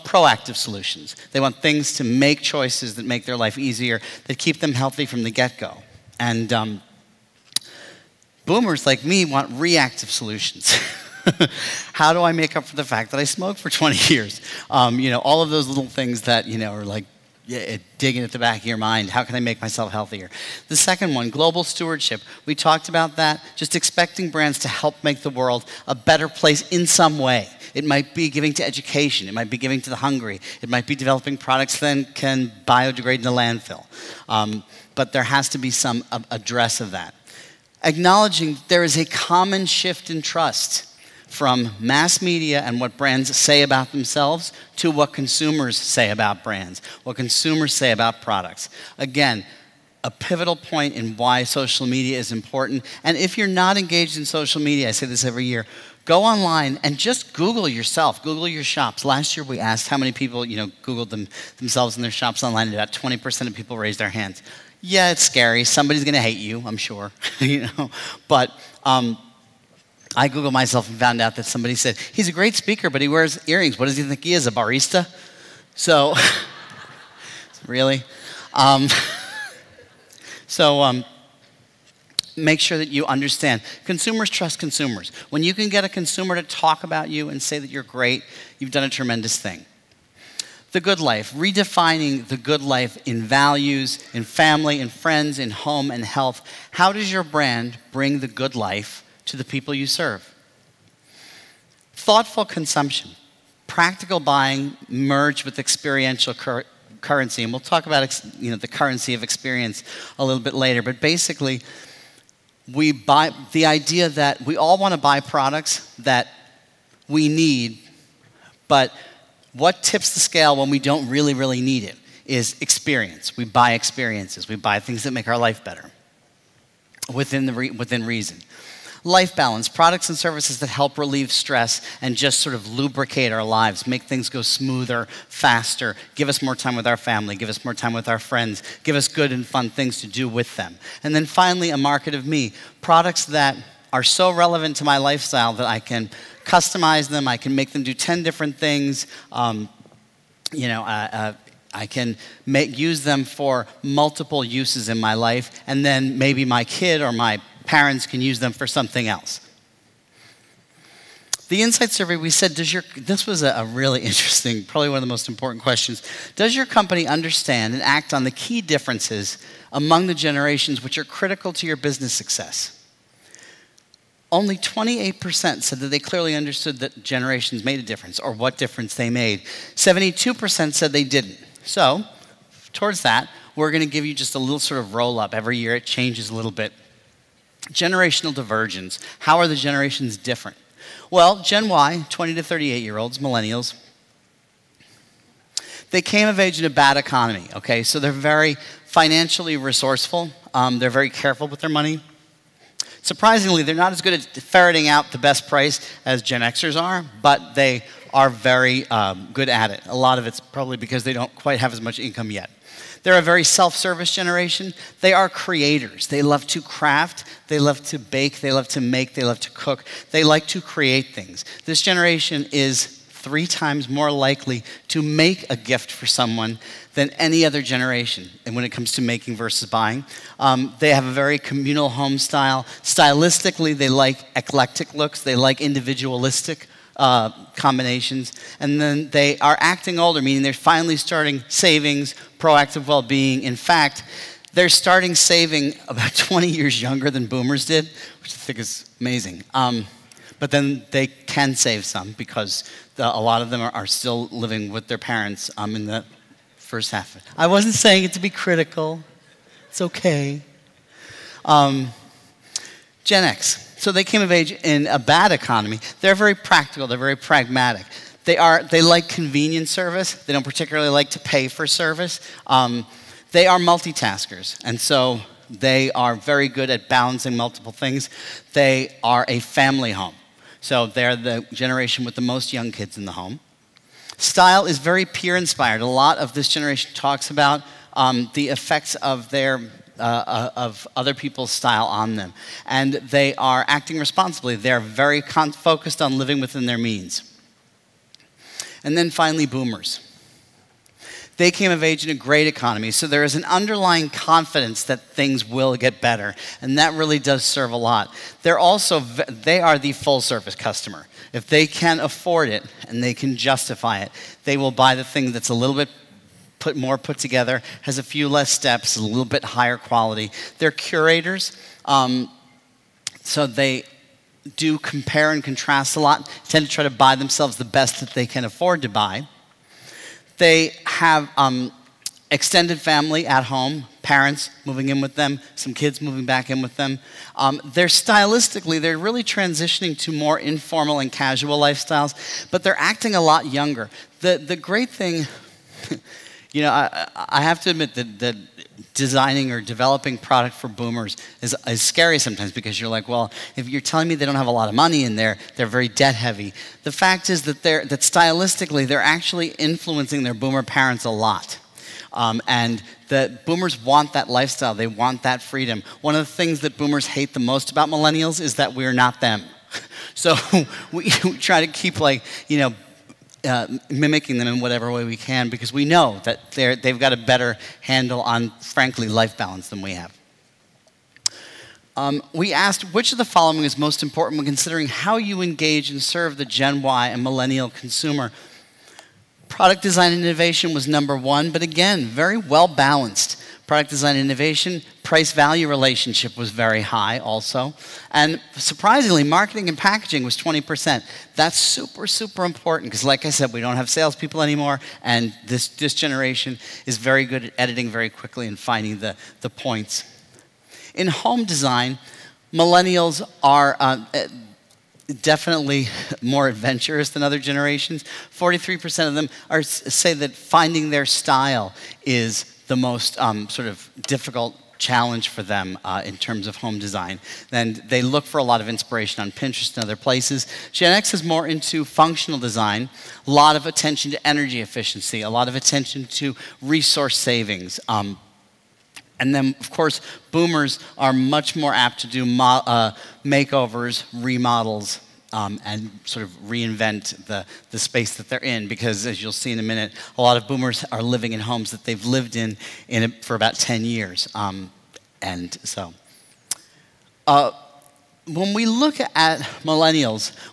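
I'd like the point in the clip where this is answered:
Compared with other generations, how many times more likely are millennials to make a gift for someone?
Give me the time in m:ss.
3:43.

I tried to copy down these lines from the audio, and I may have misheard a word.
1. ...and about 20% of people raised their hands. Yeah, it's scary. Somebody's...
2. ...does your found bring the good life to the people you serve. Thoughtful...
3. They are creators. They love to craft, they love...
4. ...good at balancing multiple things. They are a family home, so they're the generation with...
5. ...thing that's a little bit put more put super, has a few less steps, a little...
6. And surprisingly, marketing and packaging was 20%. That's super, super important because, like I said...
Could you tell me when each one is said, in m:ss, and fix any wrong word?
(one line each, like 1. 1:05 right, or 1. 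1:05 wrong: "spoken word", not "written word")
1. 1:02 right
2. 1:36 wrong: "brand", not "found"
3. 3:35 right
4. 4:36 right
5. 5:15 wrong: "together", not "super"
6. 6:38 right.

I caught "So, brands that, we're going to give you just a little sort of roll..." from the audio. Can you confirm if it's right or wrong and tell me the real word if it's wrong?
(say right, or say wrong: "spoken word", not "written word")
wrong: "towards", not "brands".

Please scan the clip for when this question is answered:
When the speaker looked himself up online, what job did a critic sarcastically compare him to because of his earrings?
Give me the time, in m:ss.
1:14.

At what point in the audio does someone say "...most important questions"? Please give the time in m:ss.
2:45.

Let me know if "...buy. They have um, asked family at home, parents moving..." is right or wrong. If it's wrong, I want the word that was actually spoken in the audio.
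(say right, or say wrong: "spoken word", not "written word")
wrong: "extended", not "asked".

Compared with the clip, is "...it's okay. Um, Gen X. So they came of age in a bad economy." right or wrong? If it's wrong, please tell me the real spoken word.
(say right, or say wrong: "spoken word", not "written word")
right.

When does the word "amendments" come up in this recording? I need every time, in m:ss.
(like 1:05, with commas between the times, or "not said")
not said.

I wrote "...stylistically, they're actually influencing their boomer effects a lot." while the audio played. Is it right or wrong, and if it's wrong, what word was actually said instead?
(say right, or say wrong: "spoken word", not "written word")
wrong: "parents", not "effects".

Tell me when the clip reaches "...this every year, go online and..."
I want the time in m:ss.
0:55.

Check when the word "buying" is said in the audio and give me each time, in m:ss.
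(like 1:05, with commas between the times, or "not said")
1:44, 3:49.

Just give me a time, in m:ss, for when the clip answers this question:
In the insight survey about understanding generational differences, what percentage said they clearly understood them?
2:54.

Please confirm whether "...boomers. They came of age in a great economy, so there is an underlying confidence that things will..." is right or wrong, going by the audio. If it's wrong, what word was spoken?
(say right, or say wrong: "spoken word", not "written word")
right.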